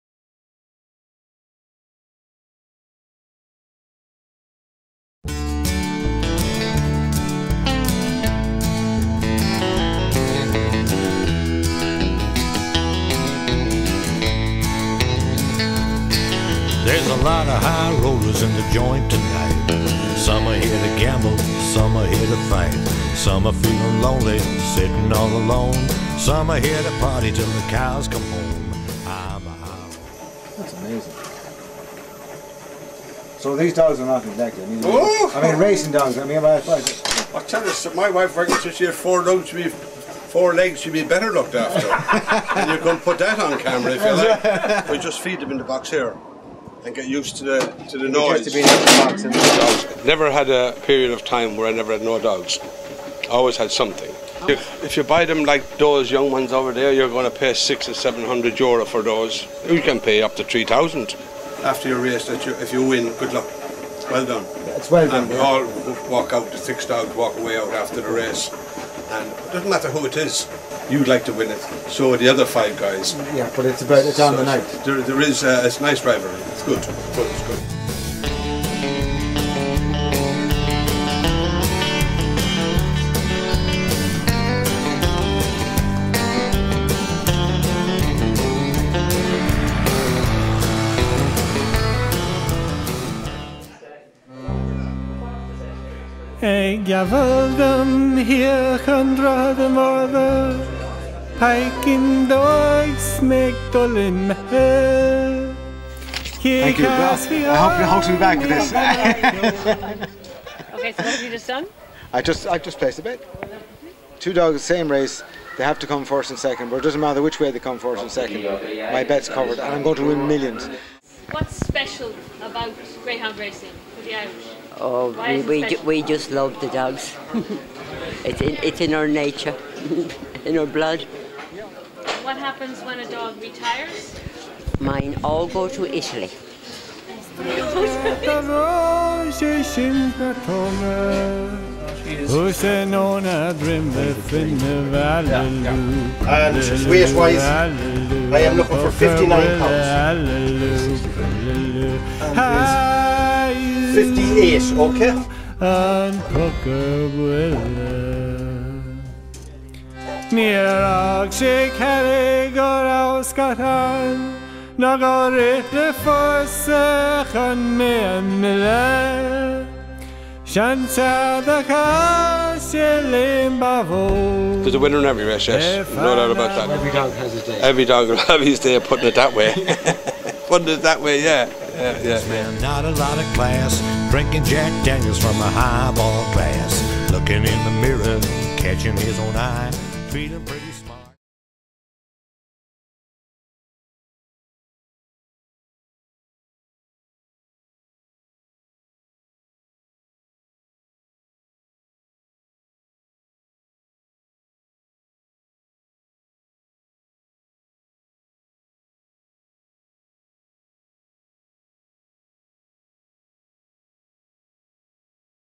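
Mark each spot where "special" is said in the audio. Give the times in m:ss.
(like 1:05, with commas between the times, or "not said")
2:01.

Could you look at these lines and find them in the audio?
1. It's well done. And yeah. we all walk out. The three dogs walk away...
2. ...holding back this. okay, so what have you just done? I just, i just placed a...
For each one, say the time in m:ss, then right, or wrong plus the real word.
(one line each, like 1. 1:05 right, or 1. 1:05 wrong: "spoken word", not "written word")
1. 1:04 wrong: "six", not "three"
2. 1:47 right.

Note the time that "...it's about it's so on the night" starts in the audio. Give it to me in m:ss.
1:13.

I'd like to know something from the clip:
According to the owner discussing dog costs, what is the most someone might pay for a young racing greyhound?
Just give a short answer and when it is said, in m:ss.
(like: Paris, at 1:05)
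3000 euro, at 1:00.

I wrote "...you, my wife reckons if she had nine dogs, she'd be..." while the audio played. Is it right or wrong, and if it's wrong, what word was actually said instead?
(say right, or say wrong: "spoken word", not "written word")
wrong: "four", not "nine".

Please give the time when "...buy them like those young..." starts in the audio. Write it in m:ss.
0:55.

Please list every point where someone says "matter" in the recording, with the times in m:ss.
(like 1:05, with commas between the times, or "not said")
1:09, 1:56.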